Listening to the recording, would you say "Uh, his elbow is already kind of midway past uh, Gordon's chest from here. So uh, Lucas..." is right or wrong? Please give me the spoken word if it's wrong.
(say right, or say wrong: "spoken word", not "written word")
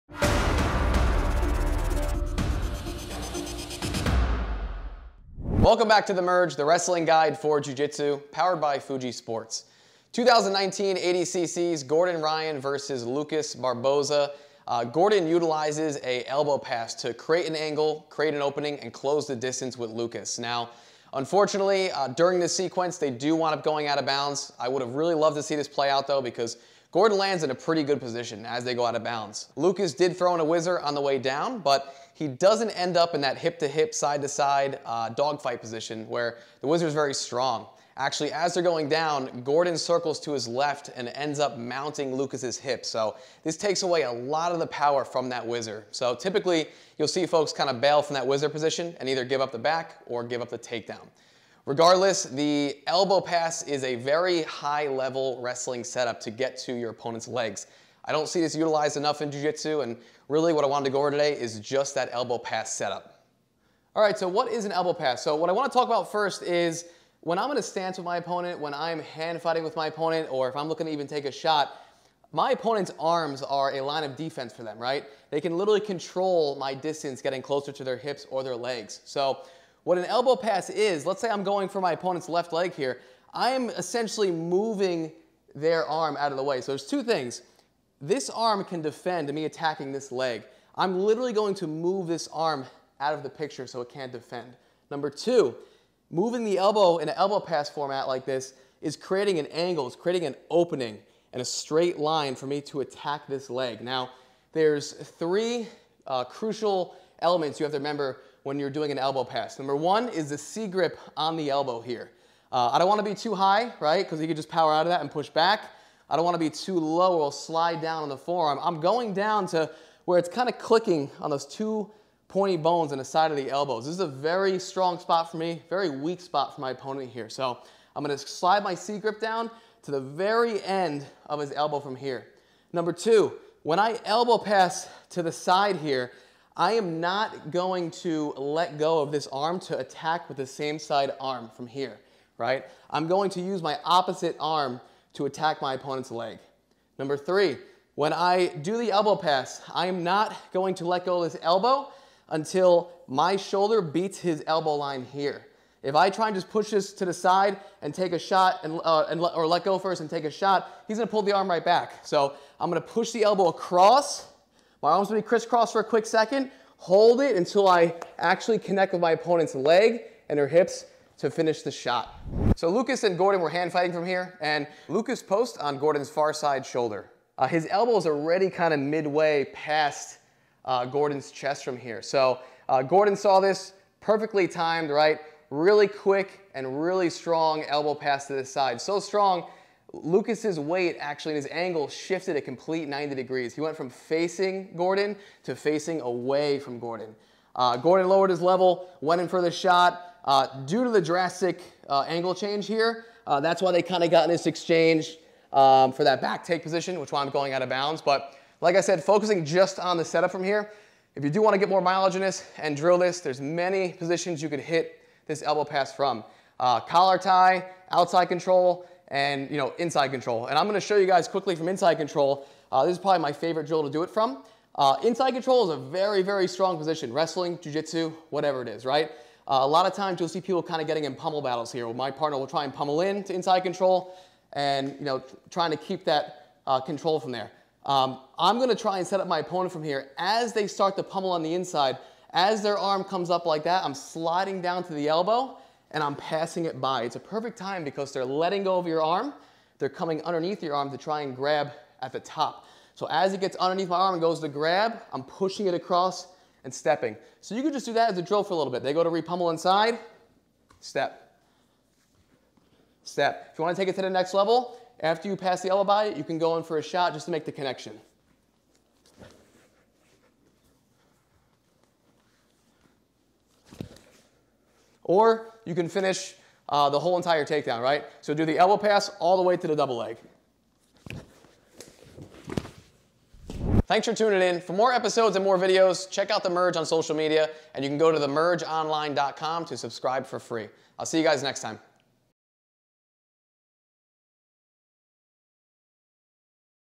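wrong: "Gordon", not "Lucas".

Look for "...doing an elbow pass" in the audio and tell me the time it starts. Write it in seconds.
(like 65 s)
108 s.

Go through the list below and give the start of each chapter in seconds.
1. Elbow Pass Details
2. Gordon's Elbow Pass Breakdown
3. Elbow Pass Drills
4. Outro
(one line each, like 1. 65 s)
1. 63 s
2. 172 s
3. 211 s
4. 283 s.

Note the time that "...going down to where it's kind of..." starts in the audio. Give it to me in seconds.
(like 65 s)
118 s.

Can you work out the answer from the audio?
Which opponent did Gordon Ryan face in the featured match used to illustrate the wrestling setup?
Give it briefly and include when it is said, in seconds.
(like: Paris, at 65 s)
Lucas Barbosa, at 13 s.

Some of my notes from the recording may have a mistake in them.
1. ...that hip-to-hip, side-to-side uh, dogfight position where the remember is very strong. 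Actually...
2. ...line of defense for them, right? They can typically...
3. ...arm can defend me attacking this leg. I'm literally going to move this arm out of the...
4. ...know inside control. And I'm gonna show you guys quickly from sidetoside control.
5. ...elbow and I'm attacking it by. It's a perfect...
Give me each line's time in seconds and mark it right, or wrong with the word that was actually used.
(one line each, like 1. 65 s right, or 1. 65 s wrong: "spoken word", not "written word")
1. 33 s wrong: "whizzer", not "remember"
2. 73 s wrong: "literally", not "typically"
3. 88 s right
4. 219 s wrong: "inside", not "sidetoside"
5. 245 s wrong: "passing", not "attacking".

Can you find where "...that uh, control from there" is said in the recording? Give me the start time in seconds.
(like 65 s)
236 s.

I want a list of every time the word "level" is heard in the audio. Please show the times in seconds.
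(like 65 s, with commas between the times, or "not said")
54 s, 198 s, 264 s.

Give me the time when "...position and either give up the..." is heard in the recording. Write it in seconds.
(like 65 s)
48 s.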